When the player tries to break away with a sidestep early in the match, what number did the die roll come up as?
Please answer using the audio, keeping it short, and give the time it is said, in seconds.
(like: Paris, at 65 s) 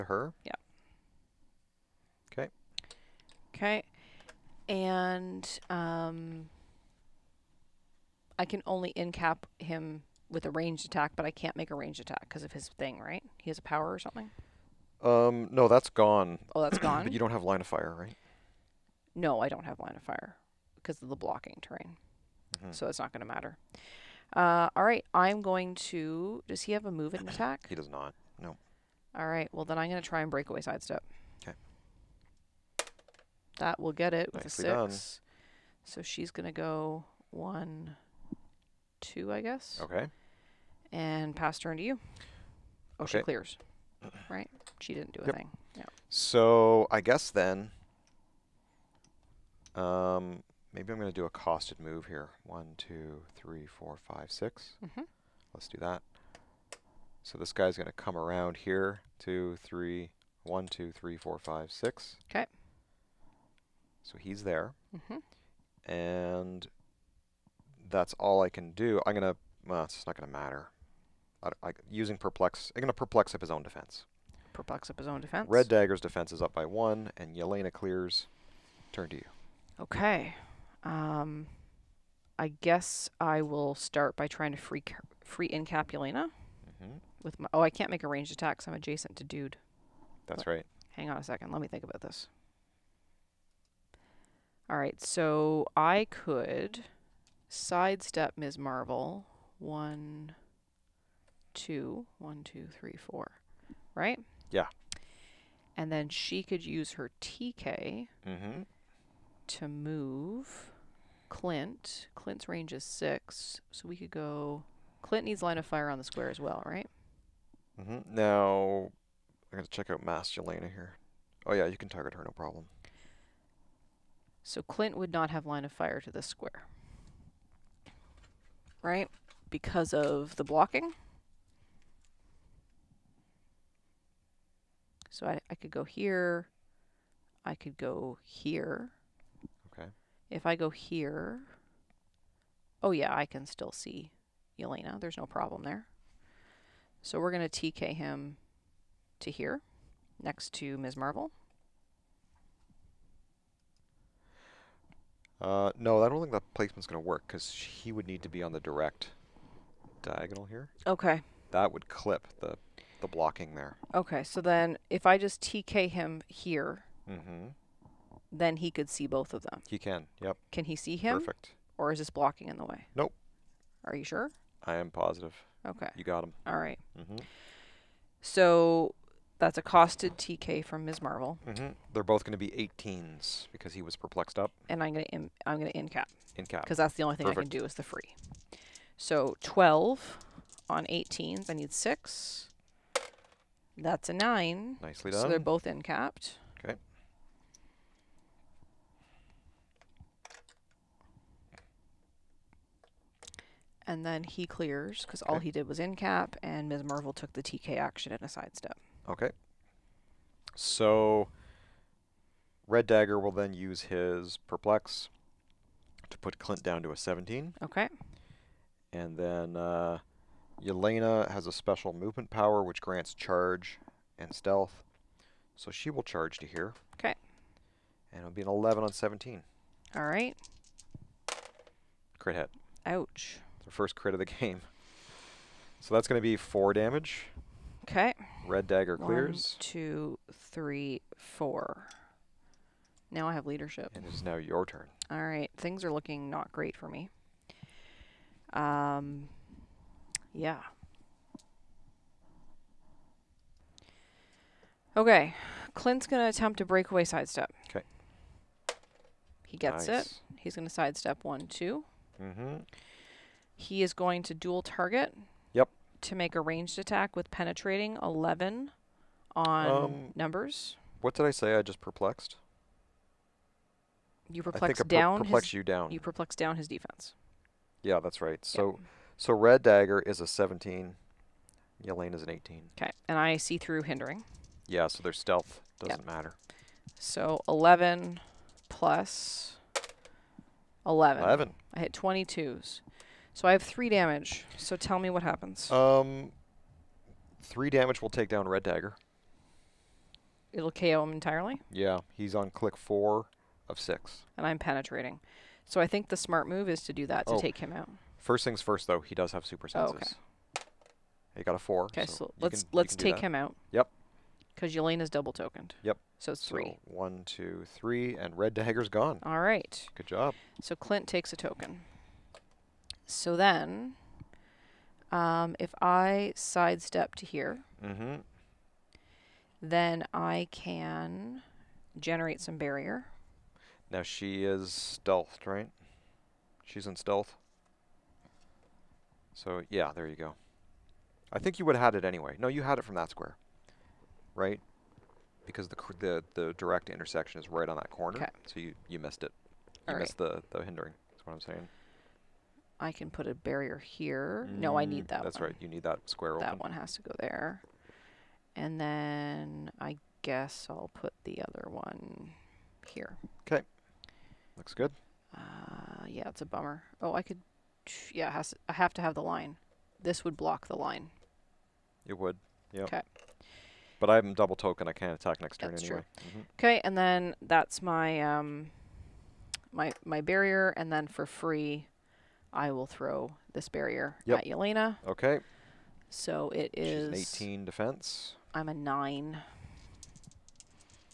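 6, at 34 s.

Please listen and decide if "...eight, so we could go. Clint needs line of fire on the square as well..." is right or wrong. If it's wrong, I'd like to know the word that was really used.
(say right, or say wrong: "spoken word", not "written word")
wrong: "six", not "eight".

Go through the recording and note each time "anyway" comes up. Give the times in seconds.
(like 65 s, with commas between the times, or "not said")
342 s, 375 s.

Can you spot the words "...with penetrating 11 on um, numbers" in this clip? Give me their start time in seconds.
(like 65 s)
267 s.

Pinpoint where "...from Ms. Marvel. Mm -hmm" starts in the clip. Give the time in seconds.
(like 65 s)
180 s.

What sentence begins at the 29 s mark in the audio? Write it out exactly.
Well, then I'm going to try and break away sidestep.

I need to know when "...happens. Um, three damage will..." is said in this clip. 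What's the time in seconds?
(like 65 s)
295 s.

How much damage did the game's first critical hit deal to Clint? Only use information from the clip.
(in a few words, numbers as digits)
4.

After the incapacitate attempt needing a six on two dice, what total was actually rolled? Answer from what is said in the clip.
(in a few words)
9.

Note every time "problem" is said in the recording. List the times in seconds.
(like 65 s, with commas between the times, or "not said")
122 s, 145 s.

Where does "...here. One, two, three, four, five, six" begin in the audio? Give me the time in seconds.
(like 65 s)
52 s.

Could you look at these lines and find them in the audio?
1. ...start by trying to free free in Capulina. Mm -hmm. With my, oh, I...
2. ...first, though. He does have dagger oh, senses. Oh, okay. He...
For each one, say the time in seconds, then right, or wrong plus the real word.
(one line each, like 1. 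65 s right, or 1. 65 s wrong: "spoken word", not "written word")
1. 83 s right
2. 308 s wrong: "super", not "dagger".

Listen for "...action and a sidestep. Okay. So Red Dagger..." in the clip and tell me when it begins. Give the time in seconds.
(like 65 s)
207 s.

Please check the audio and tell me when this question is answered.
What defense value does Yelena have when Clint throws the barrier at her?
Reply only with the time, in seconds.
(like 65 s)
387 s.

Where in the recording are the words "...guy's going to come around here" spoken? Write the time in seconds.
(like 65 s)
57 s.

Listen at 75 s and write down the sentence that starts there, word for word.
Red Dagger's defense is up by one, and Yelena clears.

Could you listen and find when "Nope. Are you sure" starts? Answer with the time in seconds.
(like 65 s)
172 s.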